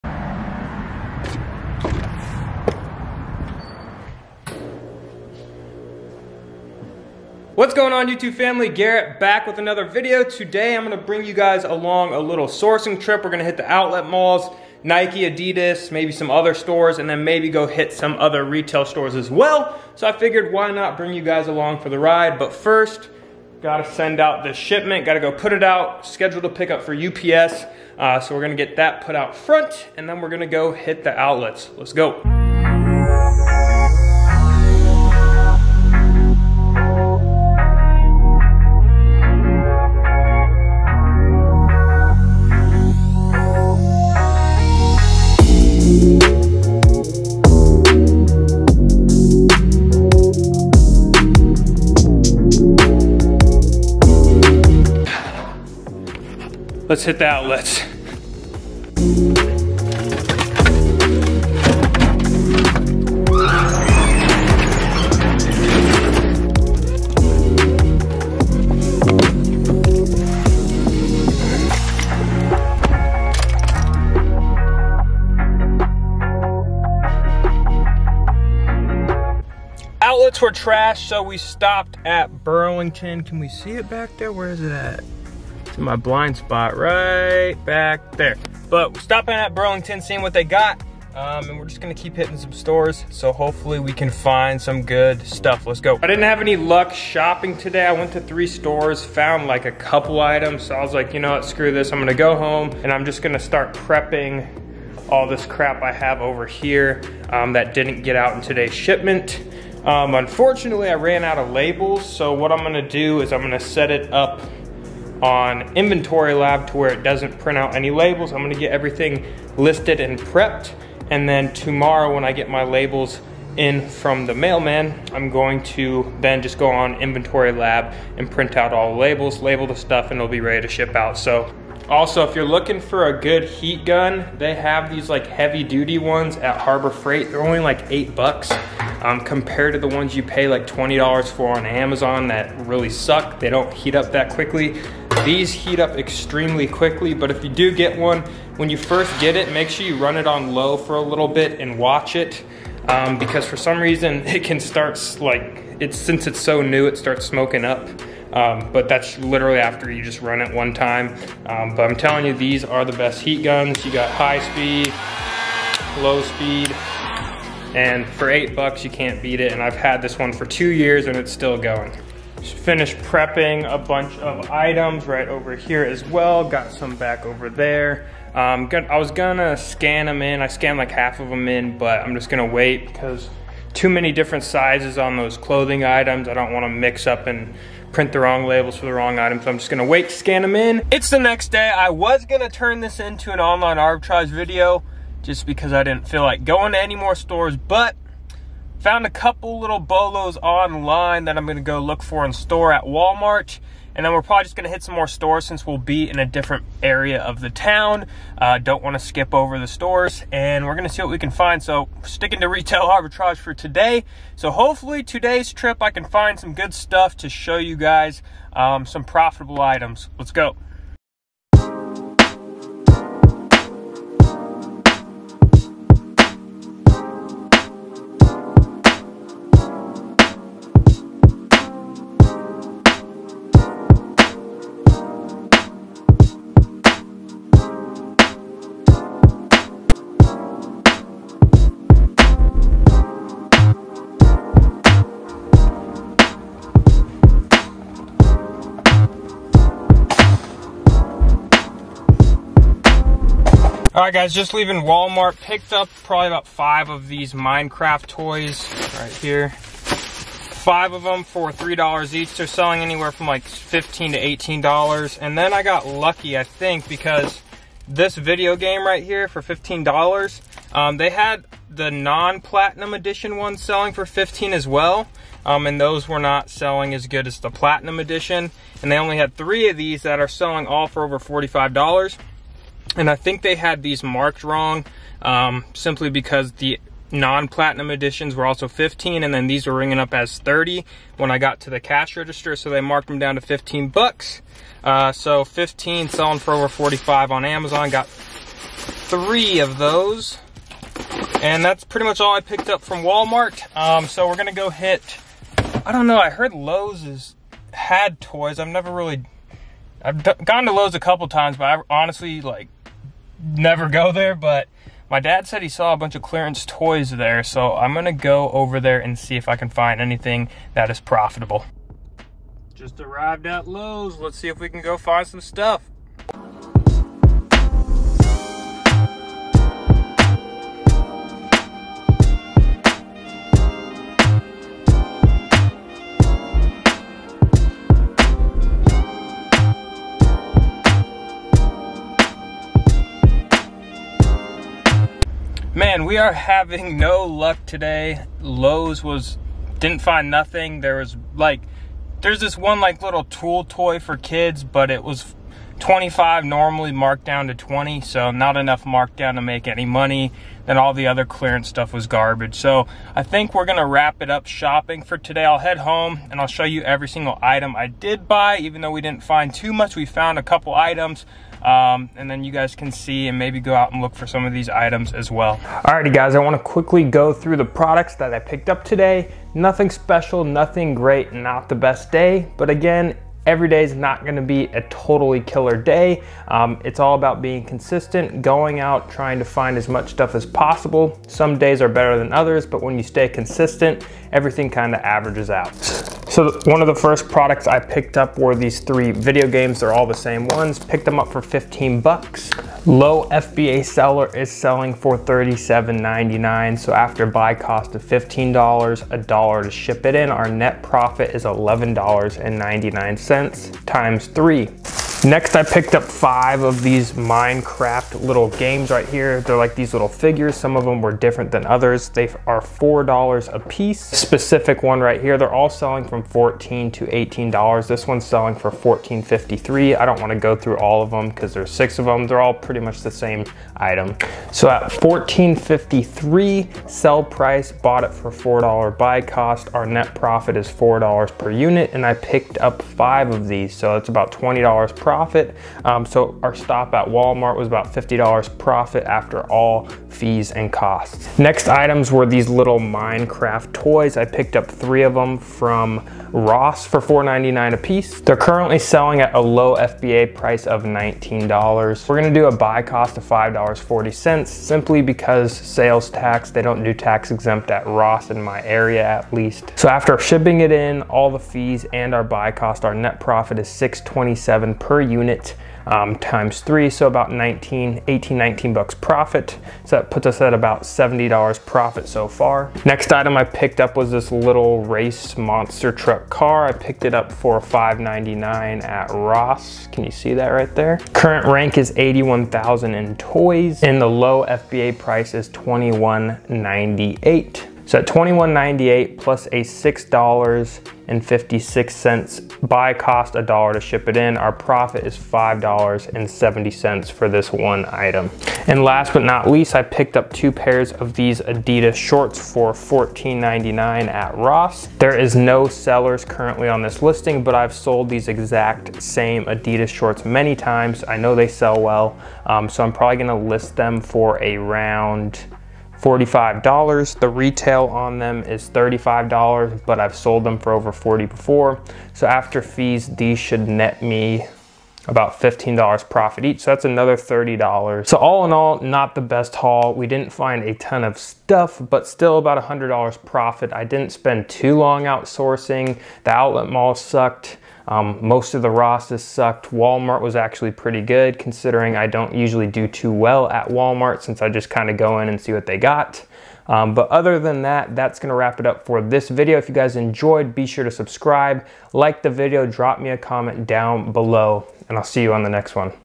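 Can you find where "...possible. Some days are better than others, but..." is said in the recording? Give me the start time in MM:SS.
06:30.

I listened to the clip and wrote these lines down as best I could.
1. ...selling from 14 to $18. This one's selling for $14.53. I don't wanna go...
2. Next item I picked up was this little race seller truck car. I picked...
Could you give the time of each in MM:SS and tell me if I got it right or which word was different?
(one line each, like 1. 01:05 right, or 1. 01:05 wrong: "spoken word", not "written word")
1. 07:05 right
2. 08:02 wrong: "monster", not "seller".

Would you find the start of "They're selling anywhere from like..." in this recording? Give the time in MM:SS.
04:22.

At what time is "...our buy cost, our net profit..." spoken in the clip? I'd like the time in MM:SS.
07:52.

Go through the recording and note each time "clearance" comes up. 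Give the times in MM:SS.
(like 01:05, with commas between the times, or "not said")
05:16, 06:01.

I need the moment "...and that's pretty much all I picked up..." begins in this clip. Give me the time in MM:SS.
05:01.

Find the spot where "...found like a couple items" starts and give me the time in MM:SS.
01:39.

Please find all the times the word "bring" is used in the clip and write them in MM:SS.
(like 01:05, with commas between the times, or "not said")
00:10, 00:20.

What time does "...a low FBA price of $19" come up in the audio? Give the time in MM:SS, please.
07:39.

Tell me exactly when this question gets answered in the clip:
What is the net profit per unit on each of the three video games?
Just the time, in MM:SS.
06:51.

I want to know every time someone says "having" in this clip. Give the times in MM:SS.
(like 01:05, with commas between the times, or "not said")
05:46.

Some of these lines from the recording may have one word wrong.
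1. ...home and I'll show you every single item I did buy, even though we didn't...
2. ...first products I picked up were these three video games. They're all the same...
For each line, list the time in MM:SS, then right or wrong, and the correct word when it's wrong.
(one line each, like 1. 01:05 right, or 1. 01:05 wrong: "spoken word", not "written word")
1. 06:05 right
2. 06:36 right.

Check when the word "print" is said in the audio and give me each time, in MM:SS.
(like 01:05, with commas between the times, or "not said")
01:57, 02:08, 03:07.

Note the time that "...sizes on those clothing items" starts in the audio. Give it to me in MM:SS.
03:04.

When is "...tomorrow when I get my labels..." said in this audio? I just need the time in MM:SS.
02:01.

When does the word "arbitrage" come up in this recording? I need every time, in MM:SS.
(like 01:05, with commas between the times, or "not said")
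03:13, 03:32.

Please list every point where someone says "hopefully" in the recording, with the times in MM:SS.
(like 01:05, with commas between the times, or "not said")
01:33, 03:34.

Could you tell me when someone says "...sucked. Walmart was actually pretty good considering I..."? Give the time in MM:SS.
09:09.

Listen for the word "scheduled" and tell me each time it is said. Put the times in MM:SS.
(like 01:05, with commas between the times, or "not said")
00:26.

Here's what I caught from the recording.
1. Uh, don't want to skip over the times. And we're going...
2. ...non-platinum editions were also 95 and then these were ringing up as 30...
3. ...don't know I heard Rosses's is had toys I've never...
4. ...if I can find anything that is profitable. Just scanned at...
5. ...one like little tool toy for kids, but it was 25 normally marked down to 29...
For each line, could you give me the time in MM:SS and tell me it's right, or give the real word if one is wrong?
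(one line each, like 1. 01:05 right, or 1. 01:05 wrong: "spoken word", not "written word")
1. 03:28 wrong: "stores", not "times"
2. 04:47 wrong: "15", not "95"
3. 05:05 wrong: "Lowe", not "Rosses"
4. 05:19 wrong: "arrived", not "scanned"
5. 05:52 wrong: "20", not "29".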